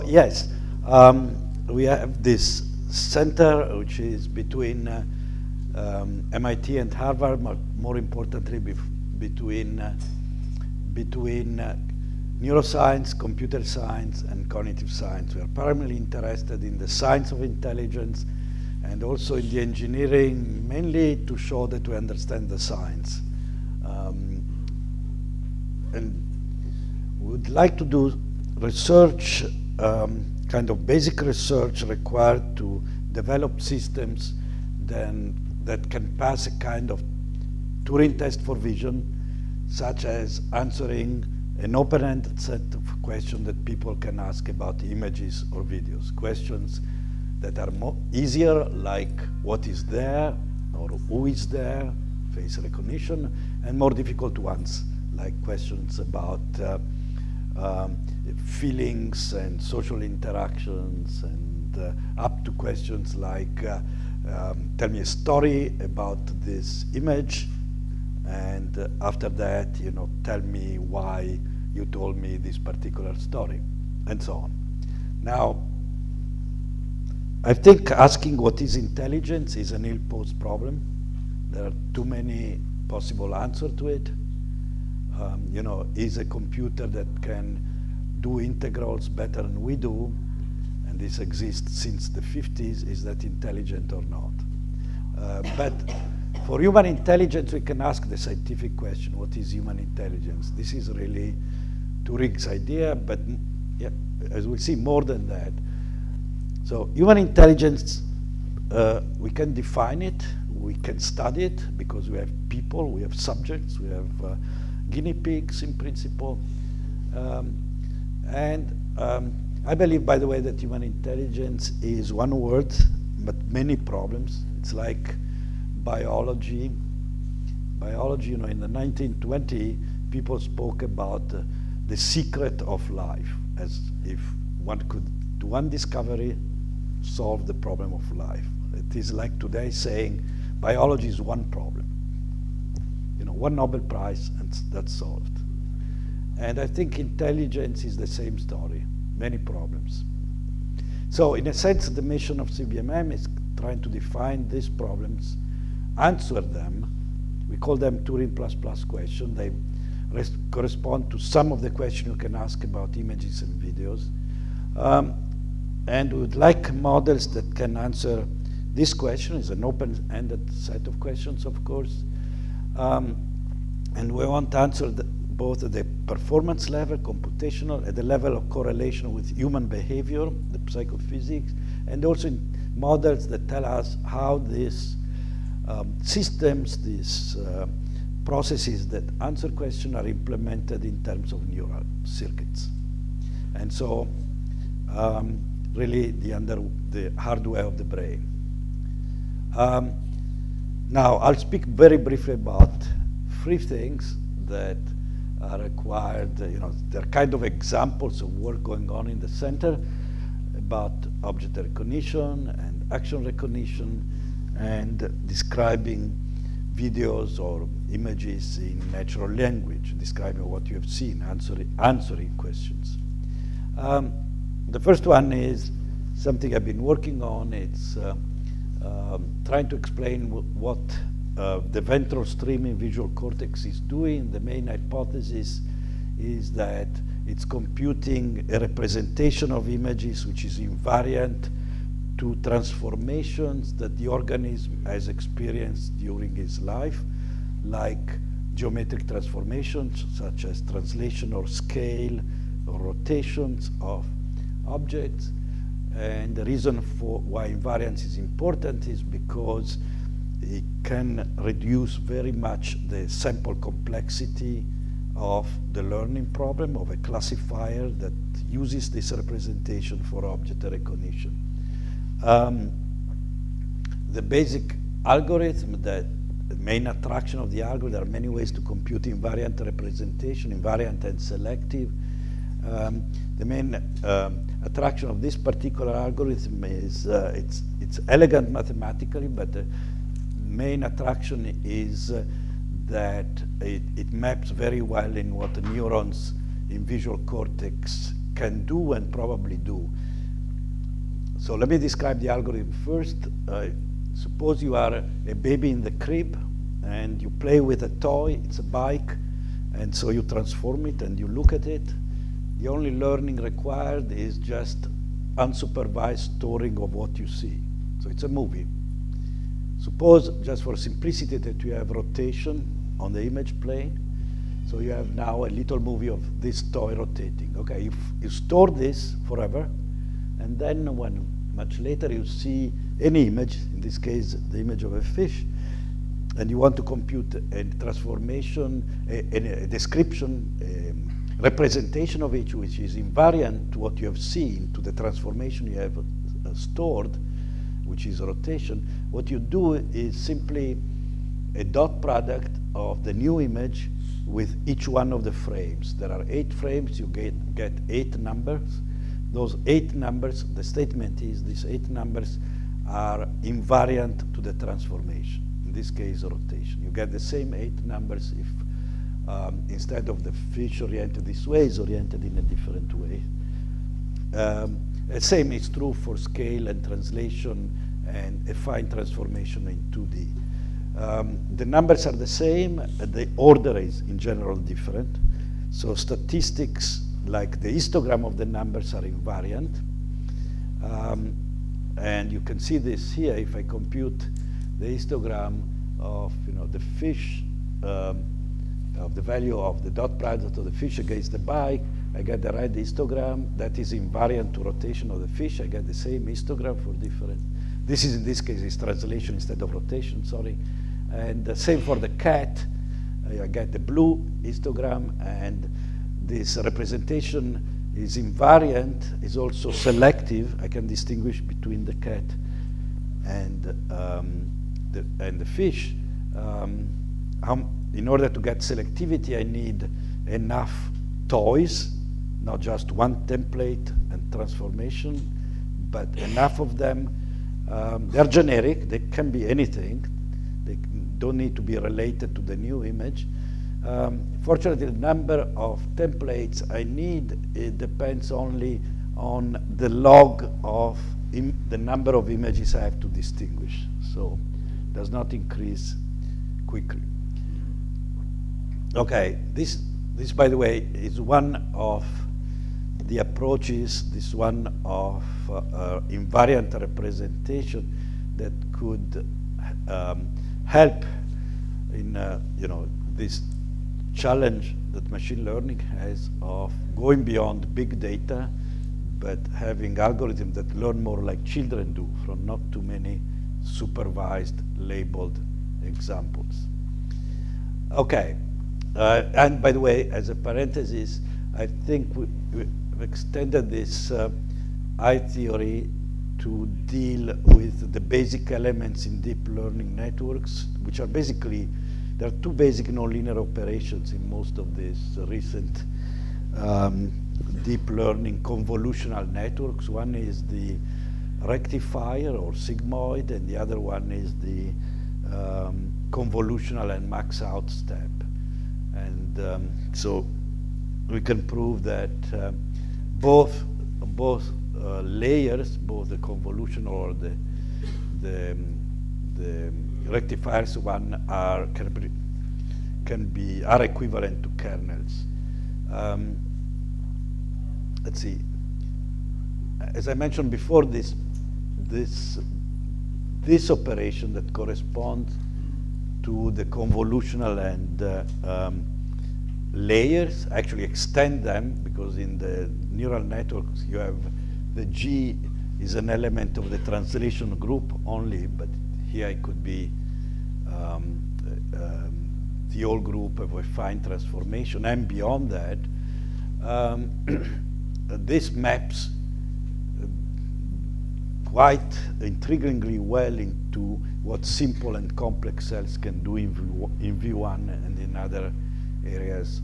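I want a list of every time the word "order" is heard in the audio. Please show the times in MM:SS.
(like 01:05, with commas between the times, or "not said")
06:23, 07:08.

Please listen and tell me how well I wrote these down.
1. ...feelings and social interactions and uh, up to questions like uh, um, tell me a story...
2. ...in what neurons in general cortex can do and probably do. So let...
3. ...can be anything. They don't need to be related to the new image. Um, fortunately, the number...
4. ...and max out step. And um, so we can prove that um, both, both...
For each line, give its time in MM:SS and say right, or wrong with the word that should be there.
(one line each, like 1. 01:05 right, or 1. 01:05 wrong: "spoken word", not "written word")
1. 00:58 right
2. 04:55 wrong: "visual", not "general"
3. 07:18 right
4. 08:36 right.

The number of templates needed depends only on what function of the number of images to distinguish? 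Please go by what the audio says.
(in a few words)
the log.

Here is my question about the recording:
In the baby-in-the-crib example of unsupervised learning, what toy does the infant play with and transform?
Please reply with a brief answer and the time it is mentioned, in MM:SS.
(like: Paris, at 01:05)
a bike, at 05:08.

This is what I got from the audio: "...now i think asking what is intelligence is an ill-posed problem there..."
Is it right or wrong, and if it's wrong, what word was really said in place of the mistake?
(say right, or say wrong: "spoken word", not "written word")
right.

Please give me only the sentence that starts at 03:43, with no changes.
Um, the first one is something I've been working on.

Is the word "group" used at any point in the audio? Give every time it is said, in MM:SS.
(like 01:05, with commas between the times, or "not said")
09:17, 09:22.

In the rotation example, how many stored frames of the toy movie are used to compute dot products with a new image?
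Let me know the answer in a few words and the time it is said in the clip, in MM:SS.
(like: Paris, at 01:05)
8, at 05:56.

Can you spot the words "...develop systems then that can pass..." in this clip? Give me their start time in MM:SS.
00:33.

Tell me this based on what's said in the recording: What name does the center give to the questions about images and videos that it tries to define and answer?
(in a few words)
Turing plus plus questions.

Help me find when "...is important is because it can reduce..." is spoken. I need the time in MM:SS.
04:18.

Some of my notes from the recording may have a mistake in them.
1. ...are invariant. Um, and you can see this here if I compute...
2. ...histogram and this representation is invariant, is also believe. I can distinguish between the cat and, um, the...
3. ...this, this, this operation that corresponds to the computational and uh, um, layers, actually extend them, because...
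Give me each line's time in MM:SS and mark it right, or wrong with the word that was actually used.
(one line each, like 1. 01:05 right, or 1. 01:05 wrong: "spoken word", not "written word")
1. 06:28 right
2. 06:54 wrong: "selective", not "believe"
3. 09:00 wrong: "convolutional", not "computational".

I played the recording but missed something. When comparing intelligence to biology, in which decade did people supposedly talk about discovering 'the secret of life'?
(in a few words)
1920s.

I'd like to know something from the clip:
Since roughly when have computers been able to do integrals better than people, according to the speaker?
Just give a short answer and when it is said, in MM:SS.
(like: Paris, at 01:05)
the 50s, at 01:31.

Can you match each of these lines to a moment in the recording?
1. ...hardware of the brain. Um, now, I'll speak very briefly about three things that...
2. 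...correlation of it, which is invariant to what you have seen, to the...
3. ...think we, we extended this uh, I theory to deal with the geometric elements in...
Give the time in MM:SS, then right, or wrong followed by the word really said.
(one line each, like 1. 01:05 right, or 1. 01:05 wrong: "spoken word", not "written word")
1. 03:17 right
2. 05:41 wrong: "representation", not "correlation"
3. 08:11 wrong: "basic", not "geometric".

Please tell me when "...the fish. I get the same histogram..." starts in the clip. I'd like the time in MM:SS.
06:45.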